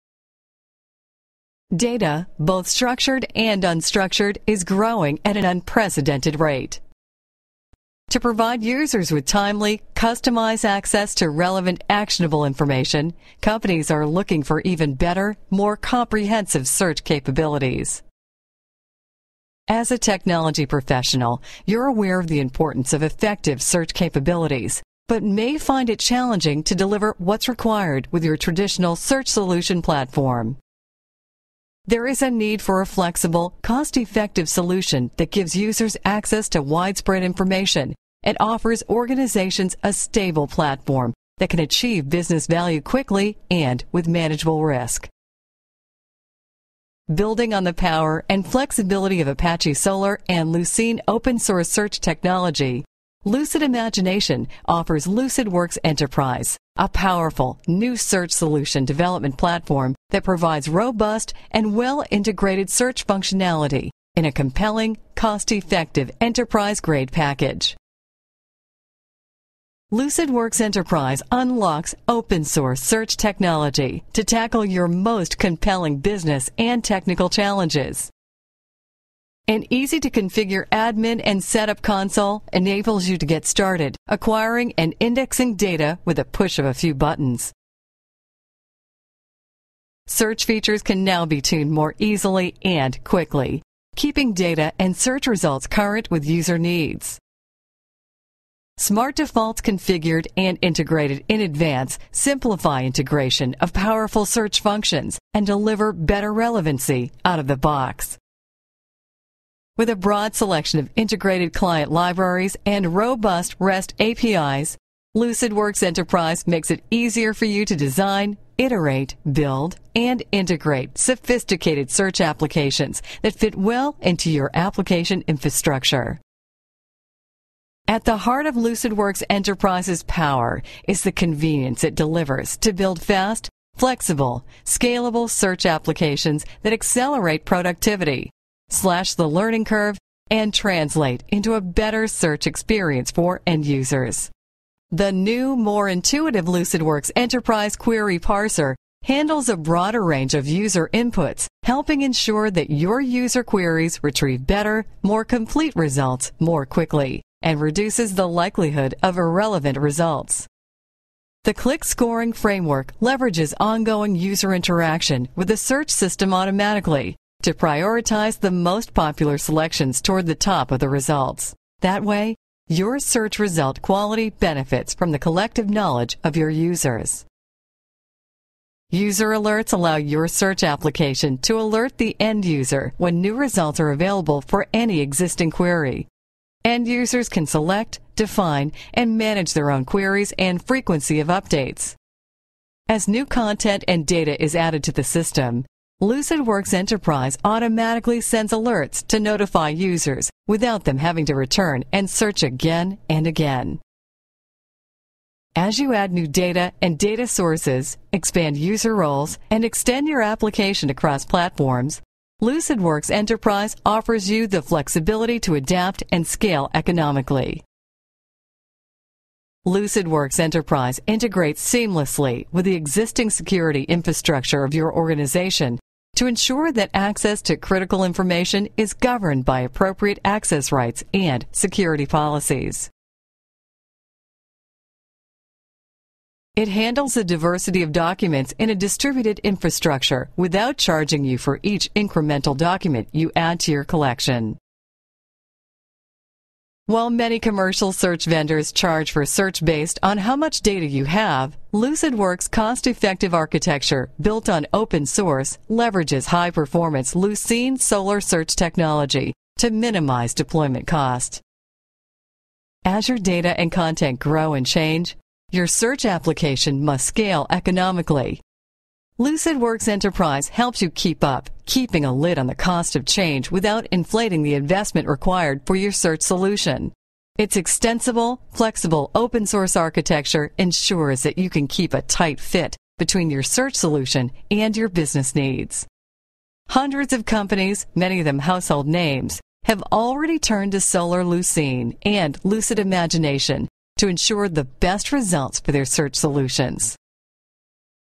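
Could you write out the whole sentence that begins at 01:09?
LucidWorks Enterprise unlocks open source search technology to tackle your most compelling business and technical challenges.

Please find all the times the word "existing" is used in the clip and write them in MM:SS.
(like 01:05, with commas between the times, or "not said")
03:04, 03:42.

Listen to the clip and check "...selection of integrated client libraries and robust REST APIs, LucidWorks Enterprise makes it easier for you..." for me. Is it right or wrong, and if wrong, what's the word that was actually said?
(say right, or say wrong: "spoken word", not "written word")
right.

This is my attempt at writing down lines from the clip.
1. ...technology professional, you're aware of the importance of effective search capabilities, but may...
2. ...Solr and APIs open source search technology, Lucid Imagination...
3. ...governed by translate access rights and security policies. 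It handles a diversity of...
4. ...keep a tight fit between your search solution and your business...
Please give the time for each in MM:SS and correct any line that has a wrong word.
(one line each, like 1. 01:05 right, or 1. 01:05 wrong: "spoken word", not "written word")
1. 00:19 right
2. 00:49 wrong: "Lucene", not "APIs"
3. 03:48 wrong: "appropriate", not "translate"
4. 04:41 right.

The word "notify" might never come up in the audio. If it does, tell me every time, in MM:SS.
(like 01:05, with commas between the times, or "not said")
03:19.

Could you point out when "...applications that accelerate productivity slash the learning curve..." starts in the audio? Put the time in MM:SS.
02:15.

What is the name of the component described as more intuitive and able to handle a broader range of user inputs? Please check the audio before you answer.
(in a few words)
LucidWorks Enterprise Query Parser.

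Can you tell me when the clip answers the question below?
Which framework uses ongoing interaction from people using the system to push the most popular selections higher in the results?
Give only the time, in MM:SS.
02:41.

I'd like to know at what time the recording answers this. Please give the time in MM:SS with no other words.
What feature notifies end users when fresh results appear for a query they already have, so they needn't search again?
02:58.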